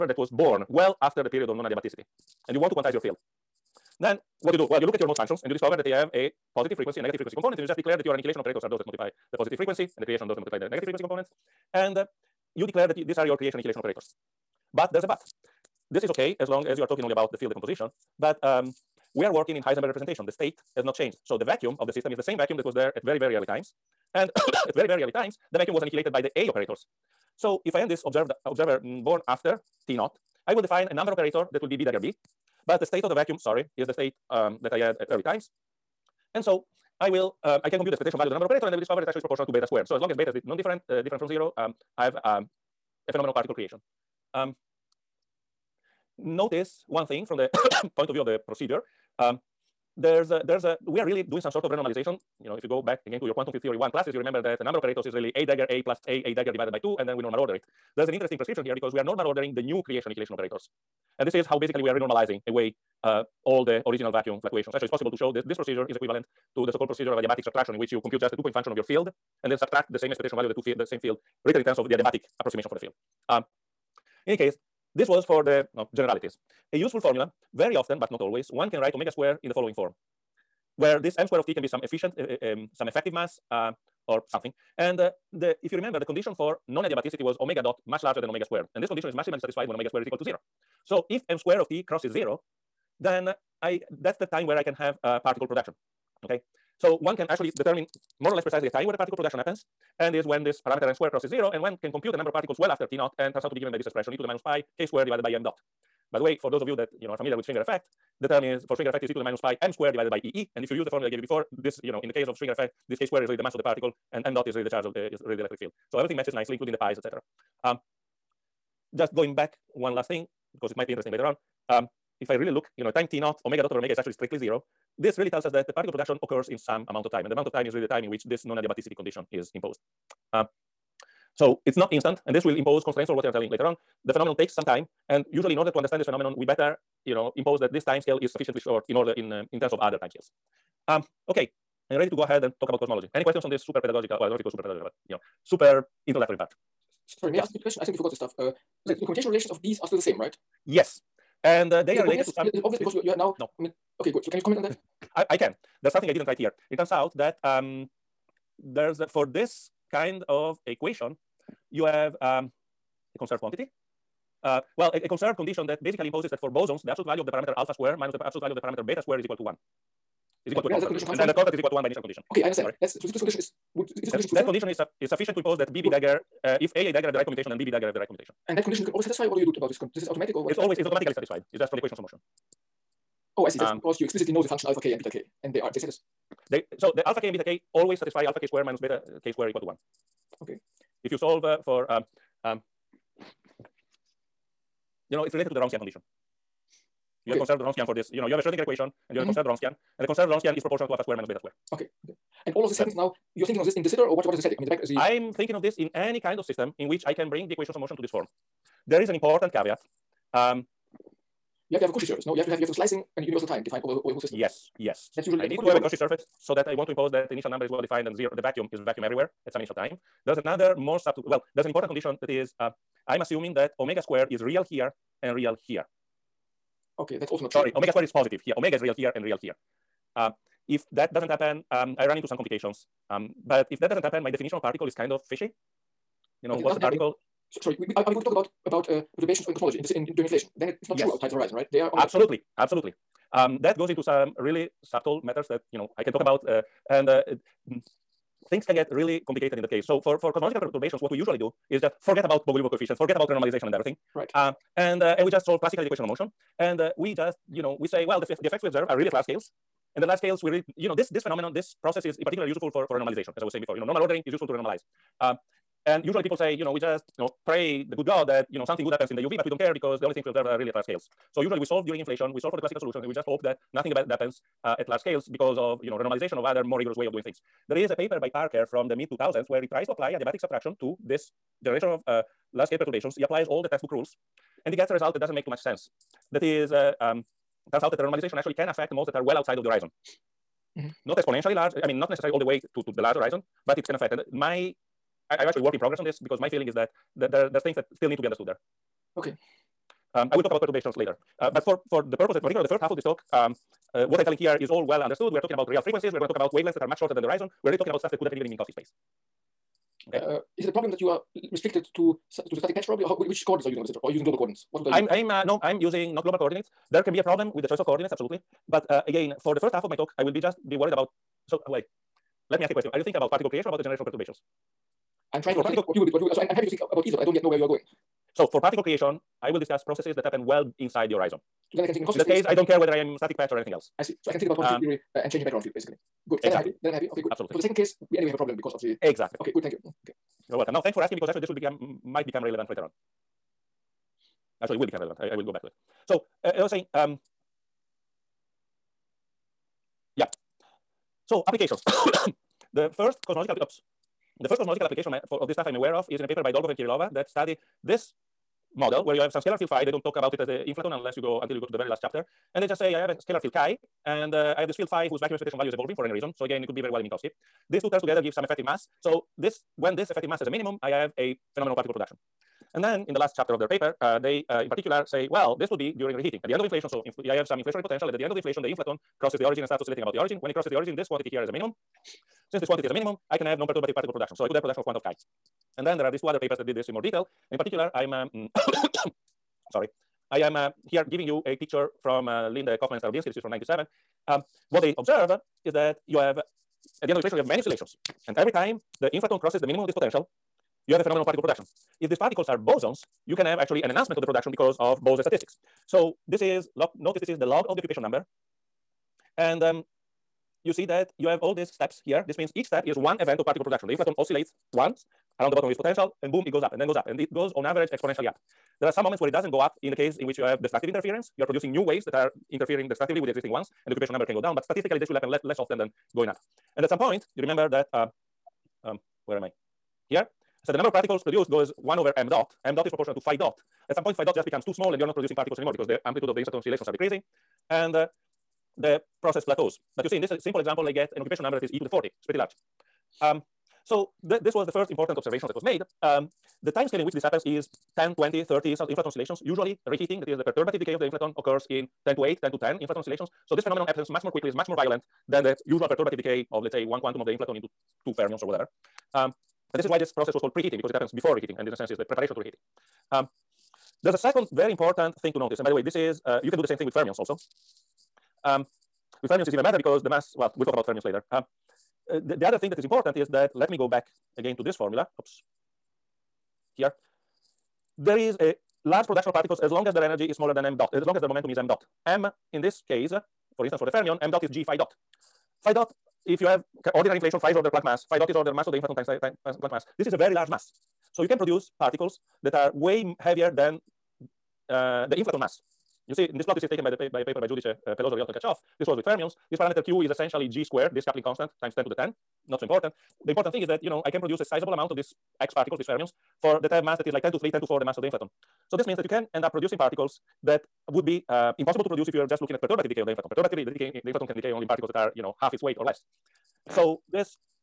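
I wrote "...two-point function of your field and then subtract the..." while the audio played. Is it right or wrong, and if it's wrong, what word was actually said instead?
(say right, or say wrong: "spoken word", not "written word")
right.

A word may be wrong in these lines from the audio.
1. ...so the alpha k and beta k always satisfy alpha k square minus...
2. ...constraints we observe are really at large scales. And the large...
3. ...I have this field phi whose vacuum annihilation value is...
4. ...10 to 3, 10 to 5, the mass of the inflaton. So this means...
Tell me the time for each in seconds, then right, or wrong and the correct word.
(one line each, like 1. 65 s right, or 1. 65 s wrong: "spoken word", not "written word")
1. 186 s right
2. 258 s wrong: "effects", not "constraints"
3. 364 s wrong: "expectation", not "annihilation"
4. 507 s wrong: "4", not "5".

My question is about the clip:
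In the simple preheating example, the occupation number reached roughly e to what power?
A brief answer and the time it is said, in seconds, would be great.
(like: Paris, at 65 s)
40, at 441 s.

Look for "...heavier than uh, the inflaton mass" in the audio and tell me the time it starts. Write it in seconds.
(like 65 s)
493 s.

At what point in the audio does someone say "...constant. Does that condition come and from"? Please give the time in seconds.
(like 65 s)
170 s.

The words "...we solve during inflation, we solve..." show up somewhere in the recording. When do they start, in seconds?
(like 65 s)
271 s.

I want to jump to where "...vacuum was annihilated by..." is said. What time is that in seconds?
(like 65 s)
25 s.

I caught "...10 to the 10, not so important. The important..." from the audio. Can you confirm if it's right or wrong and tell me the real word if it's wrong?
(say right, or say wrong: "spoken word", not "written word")
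right.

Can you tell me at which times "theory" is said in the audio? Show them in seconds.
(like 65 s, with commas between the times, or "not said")
53 s, 334 s.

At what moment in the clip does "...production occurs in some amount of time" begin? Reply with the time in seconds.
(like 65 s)
125 s.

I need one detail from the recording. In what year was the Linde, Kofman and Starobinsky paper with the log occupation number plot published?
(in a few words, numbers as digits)
1997.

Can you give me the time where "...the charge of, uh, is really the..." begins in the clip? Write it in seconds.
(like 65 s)
114 s.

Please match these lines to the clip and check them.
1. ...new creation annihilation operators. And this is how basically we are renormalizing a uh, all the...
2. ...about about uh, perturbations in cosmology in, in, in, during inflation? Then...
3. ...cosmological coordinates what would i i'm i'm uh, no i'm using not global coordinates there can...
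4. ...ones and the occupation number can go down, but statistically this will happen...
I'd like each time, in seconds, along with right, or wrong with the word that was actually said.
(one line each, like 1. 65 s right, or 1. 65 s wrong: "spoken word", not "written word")
1. 59 s right
2. 238 s right
3. 314 s wrong: "global", not "cosmological"
4. 423 s right.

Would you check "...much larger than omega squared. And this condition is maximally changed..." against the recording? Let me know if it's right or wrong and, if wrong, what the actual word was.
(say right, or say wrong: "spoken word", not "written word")
wrong: "satisfied", not "changed".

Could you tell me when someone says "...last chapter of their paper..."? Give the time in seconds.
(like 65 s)
373 s.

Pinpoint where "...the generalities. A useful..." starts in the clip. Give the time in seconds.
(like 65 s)
75 s.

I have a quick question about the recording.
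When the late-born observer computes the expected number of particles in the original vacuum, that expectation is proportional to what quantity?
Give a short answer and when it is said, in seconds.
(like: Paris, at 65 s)
beta squared, at 39 s.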